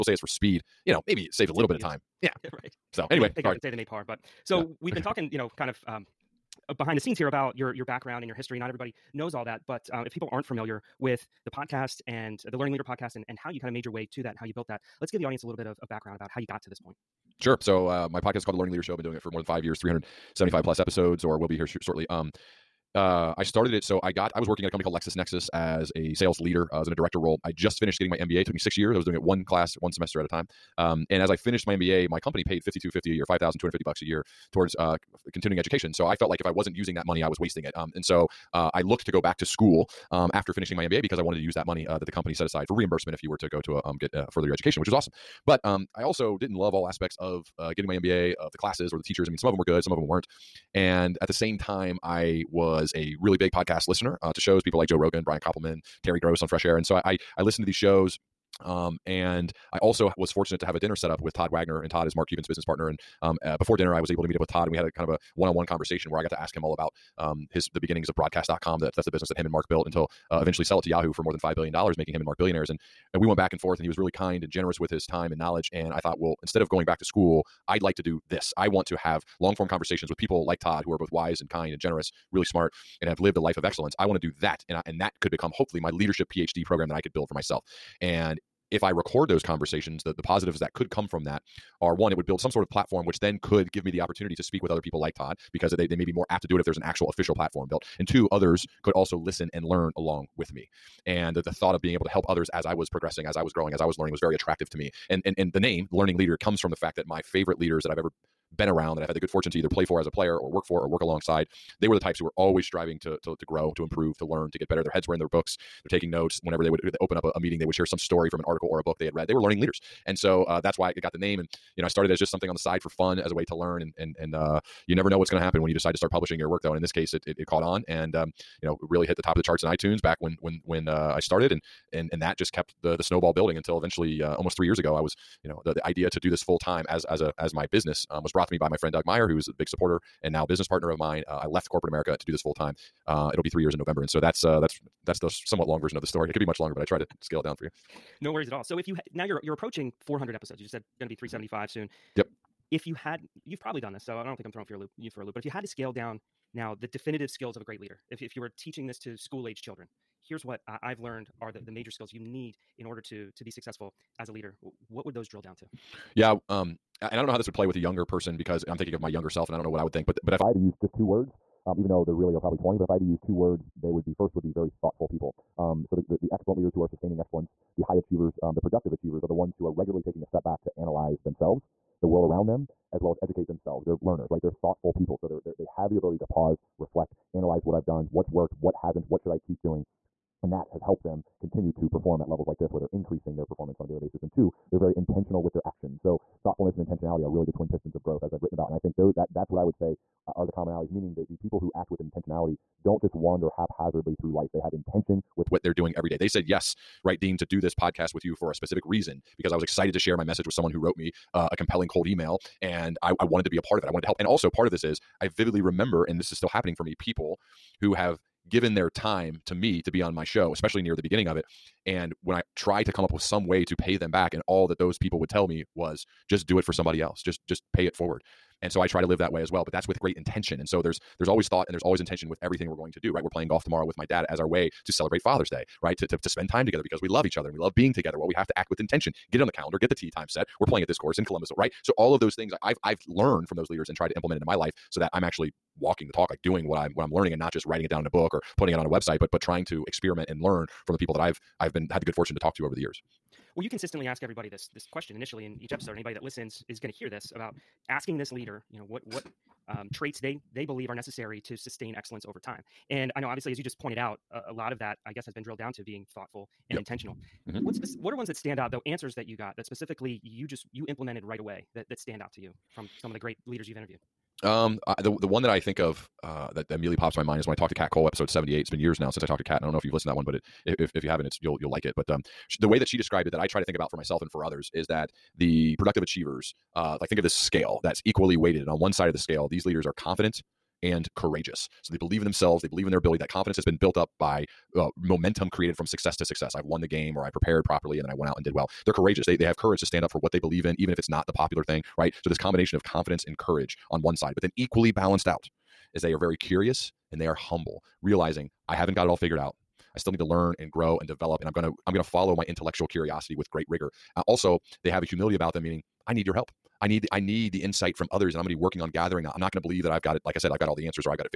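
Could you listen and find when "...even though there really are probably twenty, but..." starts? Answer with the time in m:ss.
2:51.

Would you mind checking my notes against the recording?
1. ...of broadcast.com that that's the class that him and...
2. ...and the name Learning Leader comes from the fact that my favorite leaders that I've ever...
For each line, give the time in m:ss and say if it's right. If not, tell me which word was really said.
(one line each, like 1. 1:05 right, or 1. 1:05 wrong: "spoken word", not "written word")
1. 1:08 wrong: "business", not "class"
2. 1:45 right.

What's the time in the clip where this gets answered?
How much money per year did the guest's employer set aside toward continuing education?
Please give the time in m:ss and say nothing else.
0:33.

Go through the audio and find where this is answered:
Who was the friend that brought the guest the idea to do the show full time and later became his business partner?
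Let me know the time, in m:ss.
2:18.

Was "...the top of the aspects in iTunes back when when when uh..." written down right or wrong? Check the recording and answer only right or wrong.
wrong.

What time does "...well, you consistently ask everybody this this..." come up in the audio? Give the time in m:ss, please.
4:13.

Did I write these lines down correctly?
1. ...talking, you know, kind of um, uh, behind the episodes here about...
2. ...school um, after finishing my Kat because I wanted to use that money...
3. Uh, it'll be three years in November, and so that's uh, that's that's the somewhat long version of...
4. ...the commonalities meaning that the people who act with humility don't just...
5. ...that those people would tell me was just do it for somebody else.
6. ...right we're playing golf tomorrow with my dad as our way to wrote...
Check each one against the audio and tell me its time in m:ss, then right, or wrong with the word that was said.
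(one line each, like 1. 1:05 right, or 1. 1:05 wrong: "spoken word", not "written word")
1. 0:05 wrong: "scenes", not "episodes"
2. 0:39 wrong: "MBA", not "Kat"
3. 2:23 right
4. 3:20 wrong: "intentionality", not "humility"
5. 3:44 right
6. 3:53 wrong: "celebrate", not "wrote".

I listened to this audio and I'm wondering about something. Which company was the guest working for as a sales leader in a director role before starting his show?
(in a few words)
LexisNexis.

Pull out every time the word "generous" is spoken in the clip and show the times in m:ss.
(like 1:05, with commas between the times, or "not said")
1:14, 1:21.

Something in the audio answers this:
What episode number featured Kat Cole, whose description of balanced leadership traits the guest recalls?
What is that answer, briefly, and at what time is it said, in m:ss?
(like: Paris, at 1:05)
78, at 4:38.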